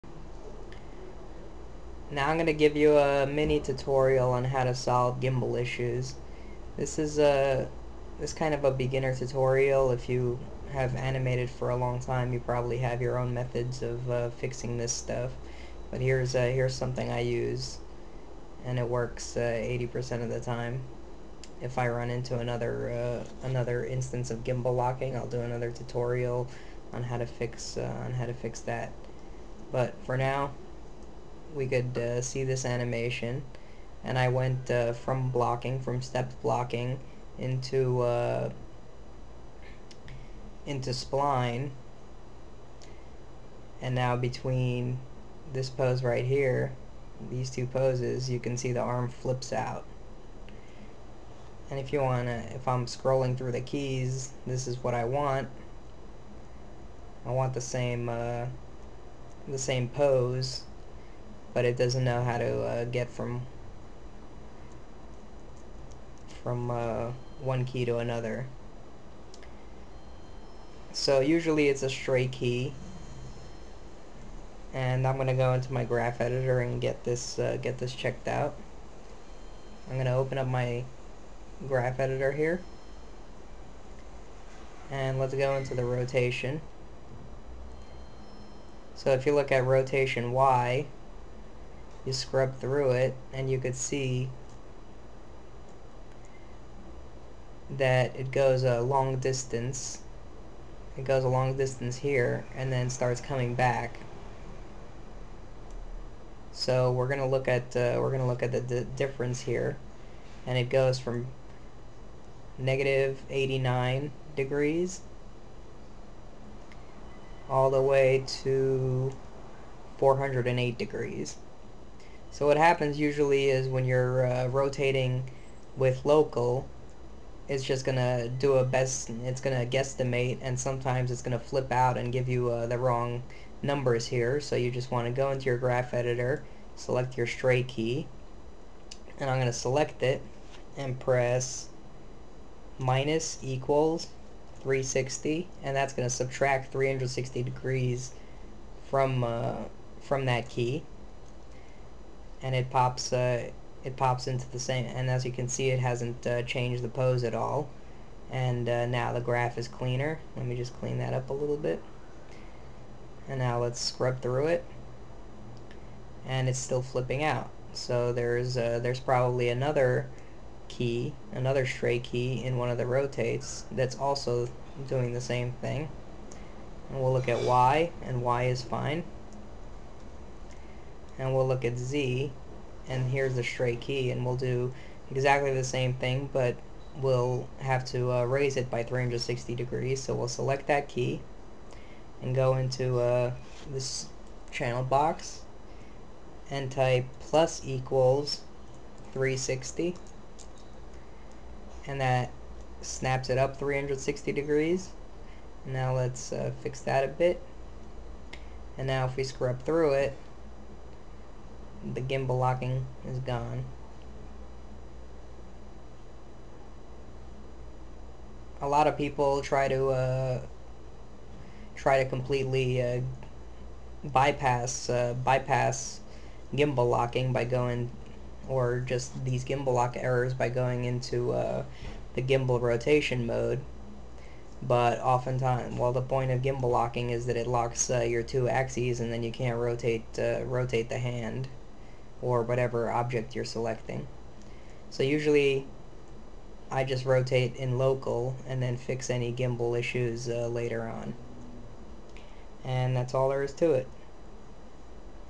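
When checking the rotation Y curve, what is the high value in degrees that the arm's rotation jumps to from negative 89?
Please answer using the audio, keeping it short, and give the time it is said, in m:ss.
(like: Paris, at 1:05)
408 degrees, at 1:59.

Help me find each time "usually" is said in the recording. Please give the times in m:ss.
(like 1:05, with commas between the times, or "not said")
1:11, 2:02, 4:05.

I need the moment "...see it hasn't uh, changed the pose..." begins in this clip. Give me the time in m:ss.
2:35.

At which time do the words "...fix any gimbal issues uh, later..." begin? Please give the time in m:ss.
4:08.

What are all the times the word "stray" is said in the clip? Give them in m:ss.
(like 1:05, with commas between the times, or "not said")
1:11, 2:17, 2:51, 3:03.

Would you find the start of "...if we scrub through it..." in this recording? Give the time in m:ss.
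3:29.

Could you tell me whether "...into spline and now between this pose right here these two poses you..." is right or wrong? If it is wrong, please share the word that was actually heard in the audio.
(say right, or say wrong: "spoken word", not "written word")
right.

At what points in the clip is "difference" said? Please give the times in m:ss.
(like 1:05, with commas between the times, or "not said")
1:48.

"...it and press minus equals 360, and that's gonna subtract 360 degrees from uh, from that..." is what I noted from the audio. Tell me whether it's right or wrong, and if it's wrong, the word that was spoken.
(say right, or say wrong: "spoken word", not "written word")
right.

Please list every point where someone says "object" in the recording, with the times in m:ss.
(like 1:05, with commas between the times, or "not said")
4:02.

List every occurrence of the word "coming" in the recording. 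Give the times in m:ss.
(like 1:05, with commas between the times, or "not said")
1:43.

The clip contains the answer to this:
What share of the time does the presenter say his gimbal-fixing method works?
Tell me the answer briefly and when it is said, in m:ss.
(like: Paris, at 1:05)
80%, at 0:19.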